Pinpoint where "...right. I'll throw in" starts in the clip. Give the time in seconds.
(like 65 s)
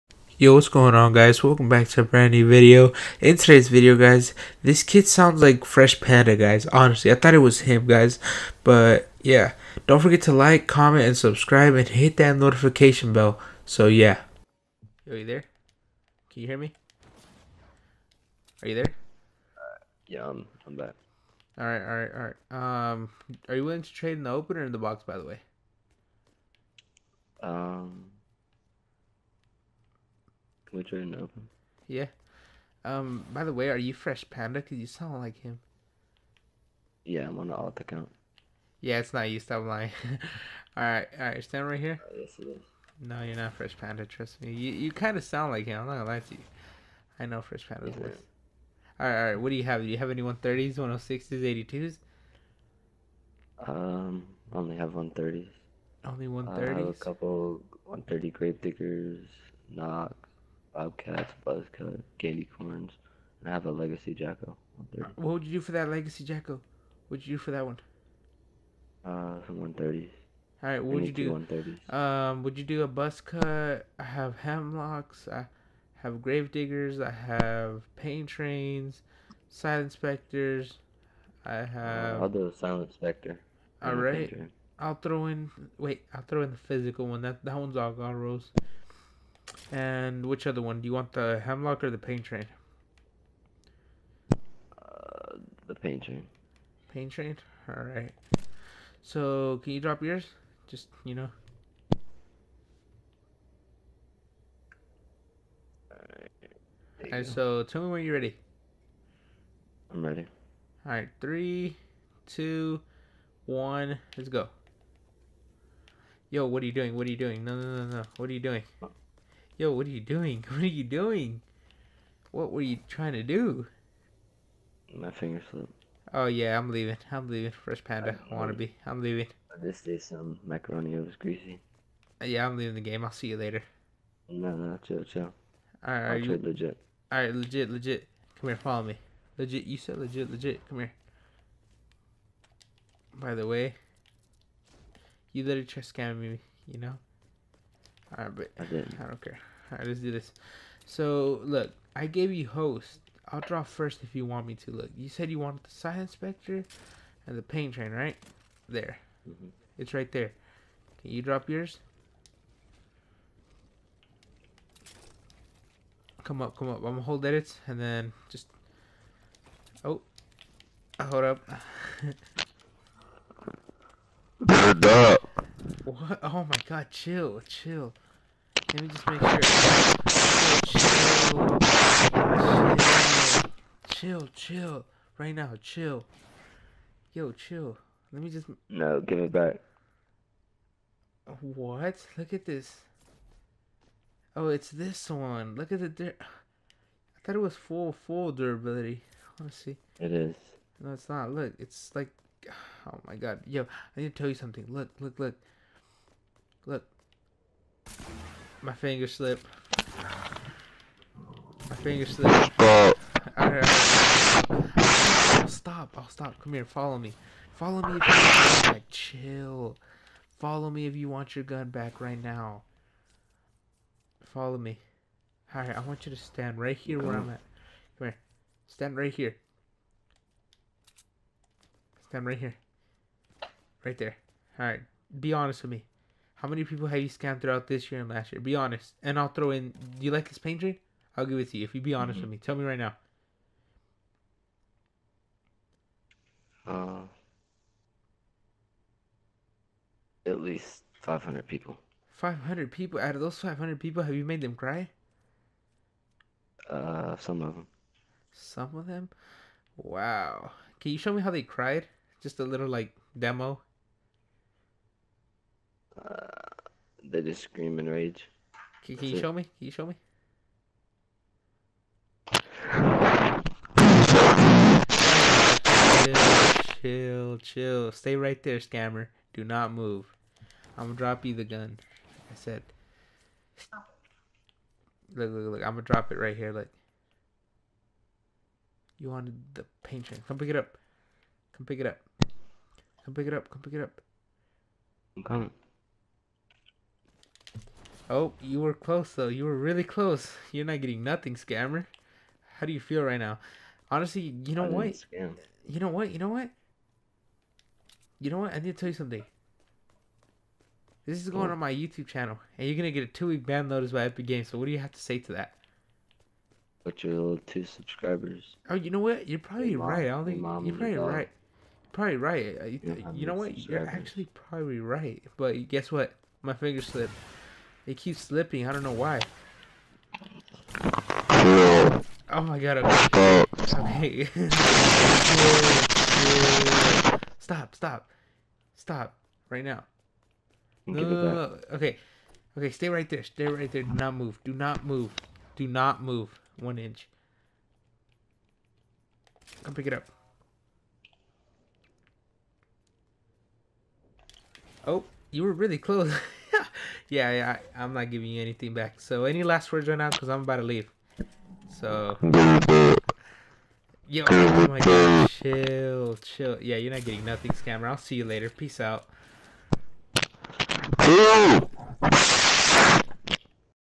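83 s.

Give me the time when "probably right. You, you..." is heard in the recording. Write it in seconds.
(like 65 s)
321 s.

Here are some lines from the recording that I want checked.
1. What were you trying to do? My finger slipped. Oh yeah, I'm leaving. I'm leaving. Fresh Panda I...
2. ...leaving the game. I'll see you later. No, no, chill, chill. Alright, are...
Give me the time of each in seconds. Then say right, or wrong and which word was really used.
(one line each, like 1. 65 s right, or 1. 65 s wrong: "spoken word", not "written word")
1. 122 s right
2. 132 s right.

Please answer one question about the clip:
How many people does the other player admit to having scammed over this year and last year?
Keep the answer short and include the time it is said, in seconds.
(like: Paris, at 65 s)
500, at 250 s.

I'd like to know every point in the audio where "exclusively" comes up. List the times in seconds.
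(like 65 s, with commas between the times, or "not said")
not said.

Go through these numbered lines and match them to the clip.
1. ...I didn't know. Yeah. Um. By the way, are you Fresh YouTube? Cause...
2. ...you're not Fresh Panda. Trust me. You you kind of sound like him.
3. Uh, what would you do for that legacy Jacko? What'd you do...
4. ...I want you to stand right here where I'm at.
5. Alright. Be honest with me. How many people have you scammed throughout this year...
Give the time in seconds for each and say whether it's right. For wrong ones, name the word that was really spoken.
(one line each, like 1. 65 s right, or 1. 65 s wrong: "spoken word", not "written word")
1. 30 s wrong: "Panda", not "YouTube"
2. 43 s right
3. 64 s right
4. 225 s right
5. 234 s right.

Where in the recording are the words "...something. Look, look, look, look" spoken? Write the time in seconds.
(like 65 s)
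204 s.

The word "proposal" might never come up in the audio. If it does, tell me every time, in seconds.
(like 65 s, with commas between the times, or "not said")
not said.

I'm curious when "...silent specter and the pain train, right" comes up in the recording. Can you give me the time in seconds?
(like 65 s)
155 s.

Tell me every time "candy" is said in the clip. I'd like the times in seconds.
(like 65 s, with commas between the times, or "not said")
62 s.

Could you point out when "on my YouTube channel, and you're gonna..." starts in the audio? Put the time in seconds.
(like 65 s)
311 s.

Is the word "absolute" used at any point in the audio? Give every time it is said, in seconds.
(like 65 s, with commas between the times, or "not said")
not said.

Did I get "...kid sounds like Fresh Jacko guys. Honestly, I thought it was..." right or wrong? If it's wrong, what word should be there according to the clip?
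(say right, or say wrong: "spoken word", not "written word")
wrong: "Panda", not "Jacko".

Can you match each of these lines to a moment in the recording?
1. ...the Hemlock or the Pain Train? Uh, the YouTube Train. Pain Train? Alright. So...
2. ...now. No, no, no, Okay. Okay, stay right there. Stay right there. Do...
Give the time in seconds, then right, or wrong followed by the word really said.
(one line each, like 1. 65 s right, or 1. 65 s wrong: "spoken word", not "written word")
1. 91 s wrong: "Pain", not "YouTube"
2. 339 s right.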